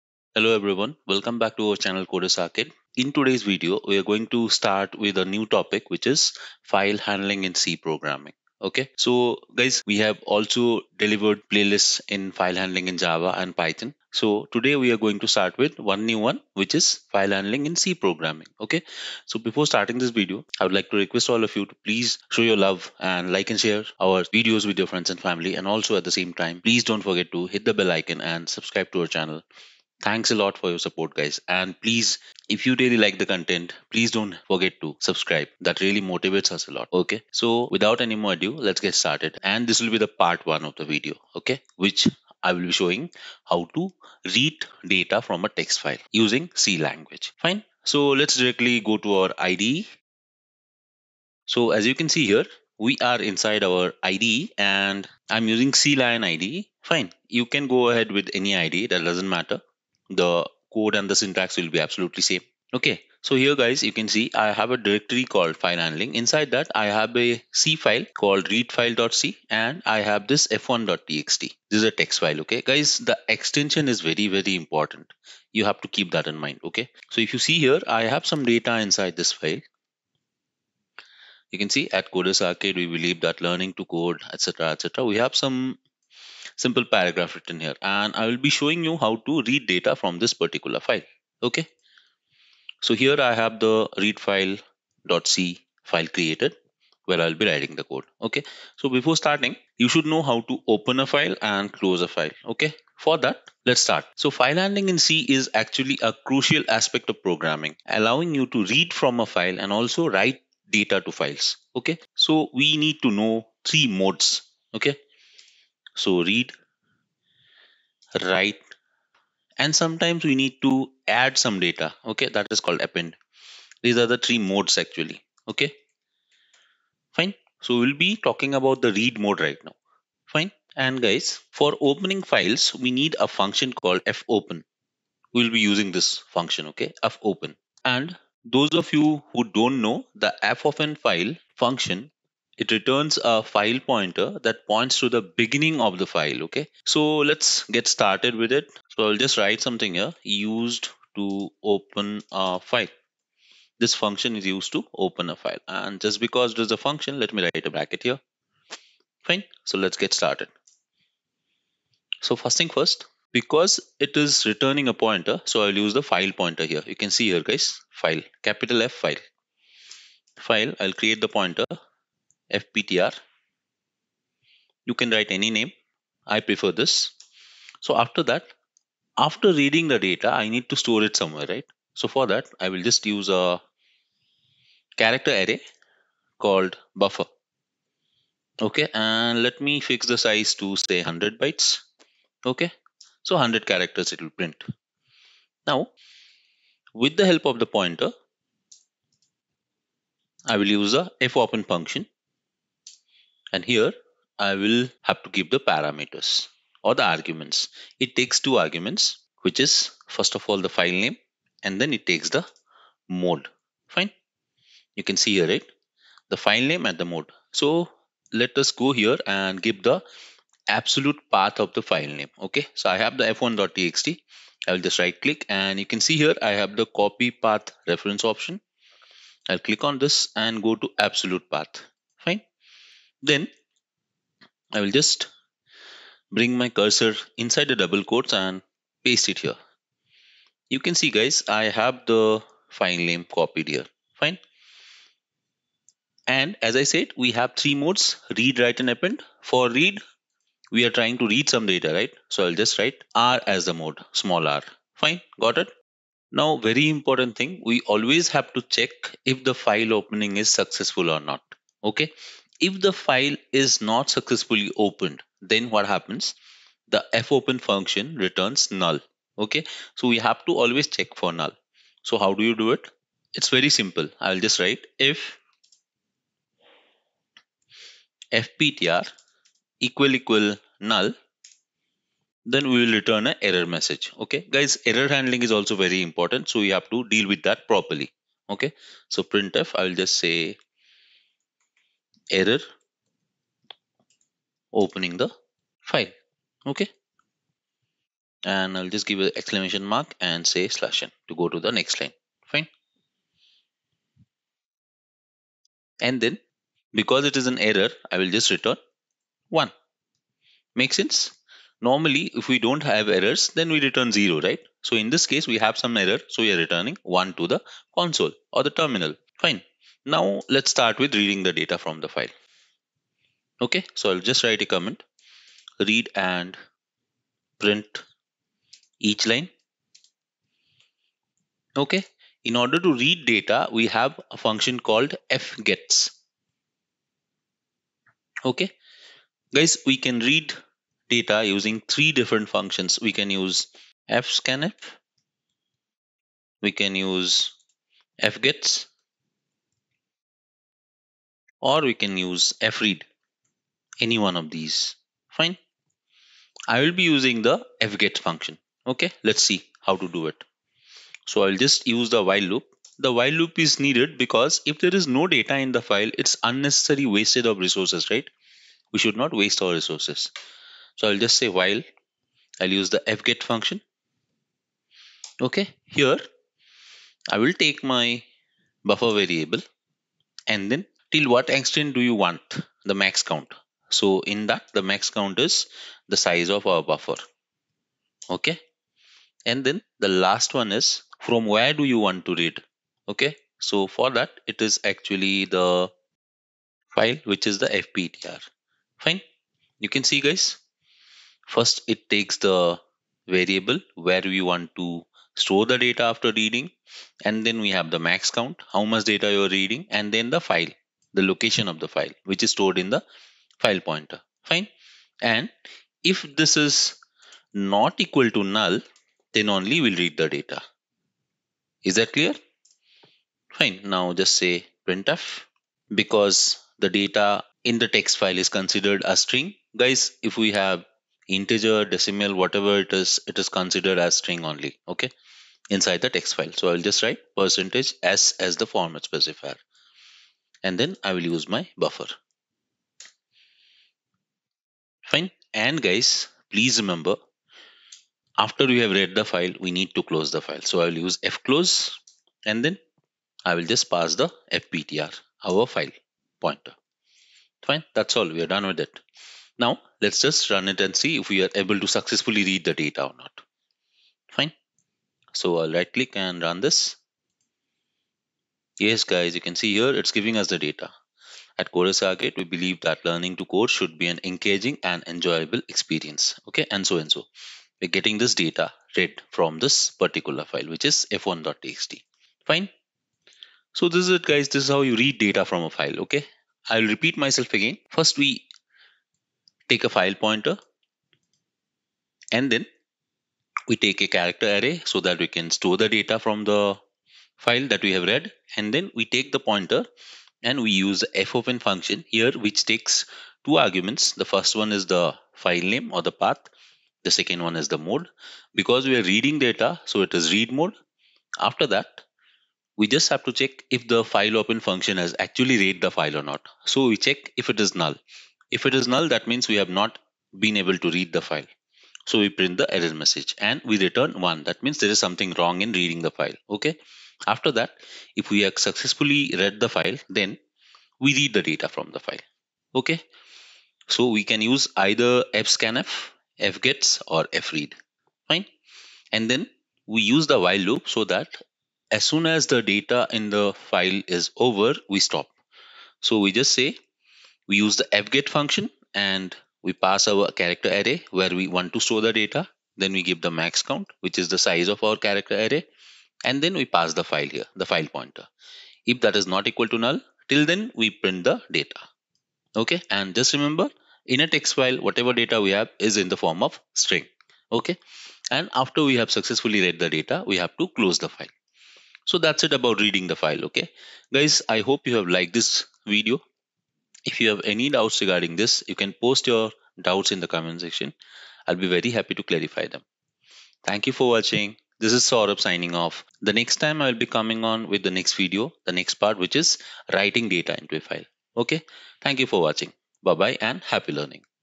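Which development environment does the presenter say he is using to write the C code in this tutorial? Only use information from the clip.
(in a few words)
CLion.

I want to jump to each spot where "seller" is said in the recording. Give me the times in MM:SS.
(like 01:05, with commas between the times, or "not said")
not said.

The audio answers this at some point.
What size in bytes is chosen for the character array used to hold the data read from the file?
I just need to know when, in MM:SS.
03:11.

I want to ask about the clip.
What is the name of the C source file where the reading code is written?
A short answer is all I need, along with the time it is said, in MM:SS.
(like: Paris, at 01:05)
readfile.c, at 01:08.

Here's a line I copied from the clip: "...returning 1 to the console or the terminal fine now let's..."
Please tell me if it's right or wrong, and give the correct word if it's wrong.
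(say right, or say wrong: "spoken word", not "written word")
right.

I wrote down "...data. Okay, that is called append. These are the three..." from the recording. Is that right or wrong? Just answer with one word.
right.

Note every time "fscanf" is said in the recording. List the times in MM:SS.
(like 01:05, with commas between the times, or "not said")
05:44, 08:55.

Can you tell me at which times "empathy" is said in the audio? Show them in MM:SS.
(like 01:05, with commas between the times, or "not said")
not said.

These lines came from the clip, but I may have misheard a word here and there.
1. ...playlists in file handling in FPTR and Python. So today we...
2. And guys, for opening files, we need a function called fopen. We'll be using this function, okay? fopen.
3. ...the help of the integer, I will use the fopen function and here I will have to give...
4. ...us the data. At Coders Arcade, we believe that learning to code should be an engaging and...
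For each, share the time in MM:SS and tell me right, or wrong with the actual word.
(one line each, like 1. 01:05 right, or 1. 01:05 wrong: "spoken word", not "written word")
1. 00:11 wrong: "Java", not "FPTR"
2. 02:10 right
3. 03:17 wrong: "pointer", not "integer"
4. 07:50 right.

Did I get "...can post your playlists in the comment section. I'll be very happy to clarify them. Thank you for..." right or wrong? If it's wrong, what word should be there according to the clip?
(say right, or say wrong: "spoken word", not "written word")
wrong: "doubts", not "playlists".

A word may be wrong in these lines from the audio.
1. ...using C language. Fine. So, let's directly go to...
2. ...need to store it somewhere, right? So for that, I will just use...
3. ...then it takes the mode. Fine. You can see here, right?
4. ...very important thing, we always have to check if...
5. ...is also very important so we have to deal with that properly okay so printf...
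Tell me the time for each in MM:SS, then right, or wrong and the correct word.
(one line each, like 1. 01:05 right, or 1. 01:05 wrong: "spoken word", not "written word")
1. 00:46 right
2. 03:00 right
3. 03:31 right
4. 04:16 right
5. 04:45 right.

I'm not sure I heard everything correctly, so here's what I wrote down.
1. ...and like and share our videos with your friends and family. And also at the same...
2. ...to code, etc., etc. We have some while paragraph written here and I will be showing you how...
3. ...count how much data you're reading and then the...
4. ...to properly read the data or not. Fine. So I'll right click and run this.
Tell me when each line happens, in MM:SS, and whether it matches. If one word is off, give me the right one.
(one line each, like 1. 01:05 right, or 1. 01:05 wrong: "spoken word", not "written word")
1. 00:23 right
2. 01:23 wrong: "simple", not "while"
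3. 06:48 right
4. 07:41 wrong: "successfully", not "properly".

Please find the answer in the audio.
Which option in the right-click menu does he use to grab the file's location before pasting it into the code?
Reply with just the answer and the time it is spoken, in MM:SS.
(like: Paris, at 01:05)
copy path reference, at 03:46.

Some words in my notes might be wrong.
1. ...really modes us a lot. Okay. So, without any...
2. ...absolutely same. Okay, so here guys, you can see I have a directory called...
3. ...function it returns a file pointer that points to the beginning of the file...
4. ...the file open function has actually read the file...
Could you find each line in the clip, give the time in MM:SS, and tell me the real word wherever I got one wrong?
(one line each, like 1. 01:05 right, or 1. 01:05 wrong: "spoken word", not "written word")
1. 00:35 wrong: "motivates", not "modes"
2. 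01:01 right
3. 02:21 right
4. 08:33 right.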